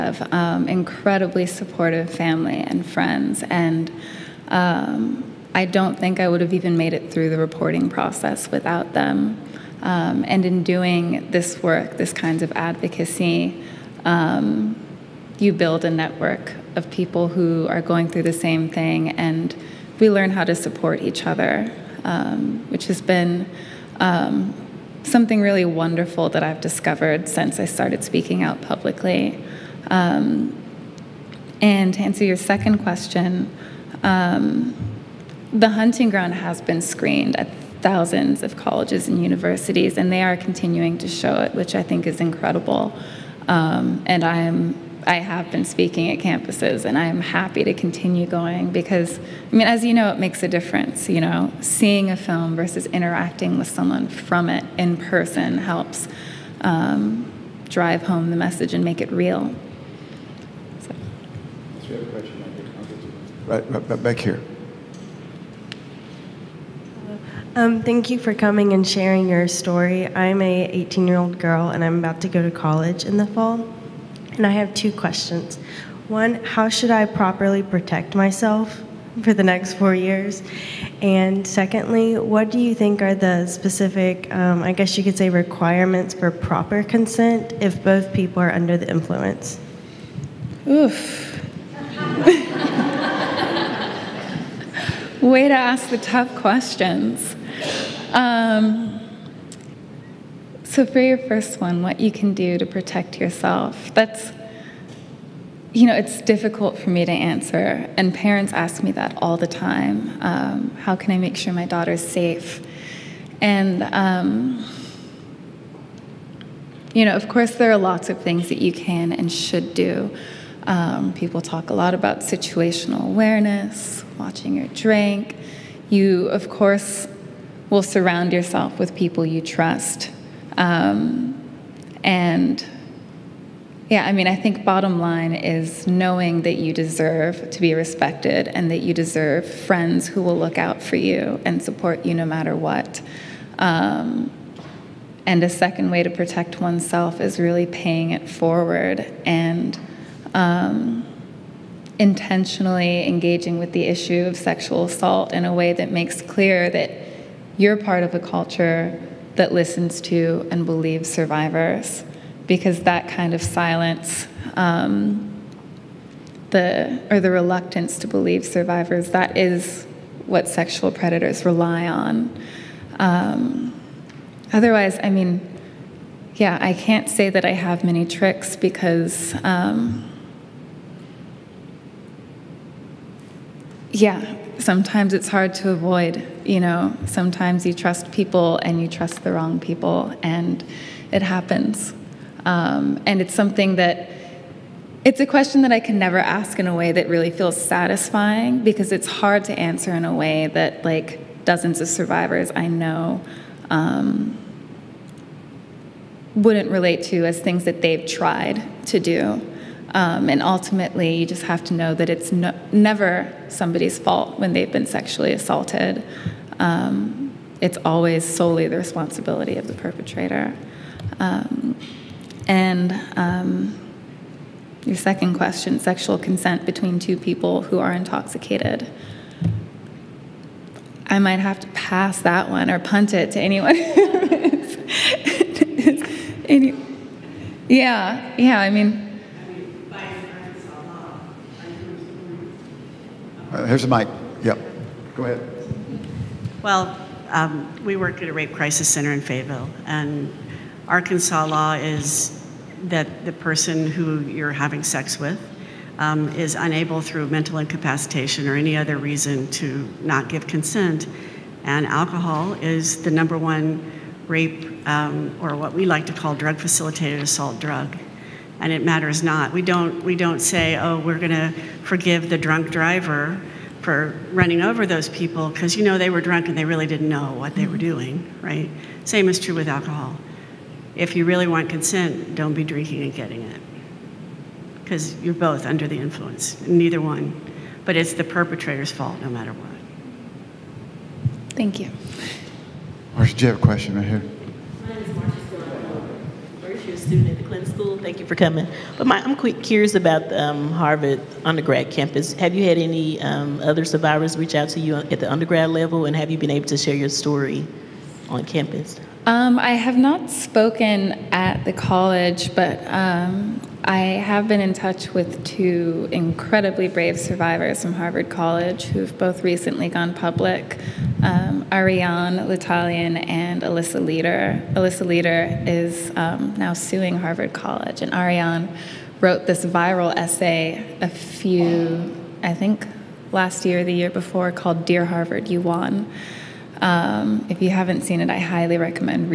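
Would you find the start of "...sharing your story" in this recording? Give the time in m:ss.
1:08.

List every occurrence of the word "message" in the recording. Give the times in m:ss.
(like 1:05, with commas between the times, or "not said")
0:58.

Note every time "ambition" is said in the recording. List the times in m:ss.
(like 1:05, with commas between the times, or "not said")
not said.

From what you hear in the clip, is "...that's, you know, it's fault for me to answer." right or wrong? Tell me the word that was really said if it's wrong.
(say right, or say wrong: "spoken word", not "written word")
wrong: "difficult", not "fault".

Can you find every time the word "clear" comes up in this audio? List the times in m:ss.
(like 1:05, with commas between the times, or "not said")
2:36.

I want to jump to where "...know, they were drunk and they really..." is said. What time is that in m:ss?
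4:35.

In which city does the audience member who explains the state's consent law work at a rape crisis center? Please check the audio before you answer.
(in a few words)
Fayetteville.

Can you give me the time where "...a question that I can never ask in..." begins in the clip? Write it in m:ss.
3:15.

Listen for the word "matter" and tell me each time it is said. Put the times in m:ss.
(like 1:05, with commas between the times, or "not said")
2:22, 4:28, 4:49.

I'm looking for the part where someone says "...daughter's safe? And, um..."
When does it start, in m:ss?
1:51.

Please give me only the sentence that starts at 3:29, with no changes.
Um, and ultimately, you just have to know that it's no, never somebody's fault when they've been sexually assaulted.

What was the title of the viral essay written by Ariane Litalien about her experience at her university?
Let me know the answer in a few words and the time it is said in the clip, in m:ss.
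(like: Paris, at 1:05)
Dear Harvard, You Won, at 5:34.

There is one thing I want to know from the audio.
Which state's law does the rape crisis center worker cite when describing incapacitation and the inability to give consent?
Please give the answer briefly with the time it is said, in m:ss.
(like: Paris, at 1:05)
Arkansas, at 4:10.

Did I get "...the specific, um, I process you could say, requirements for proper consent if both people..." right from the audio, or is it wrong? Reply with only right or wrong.
wrong.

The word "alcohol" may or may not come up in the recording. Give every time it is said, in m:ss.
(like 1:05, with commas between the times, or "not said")
4:21, 4:39.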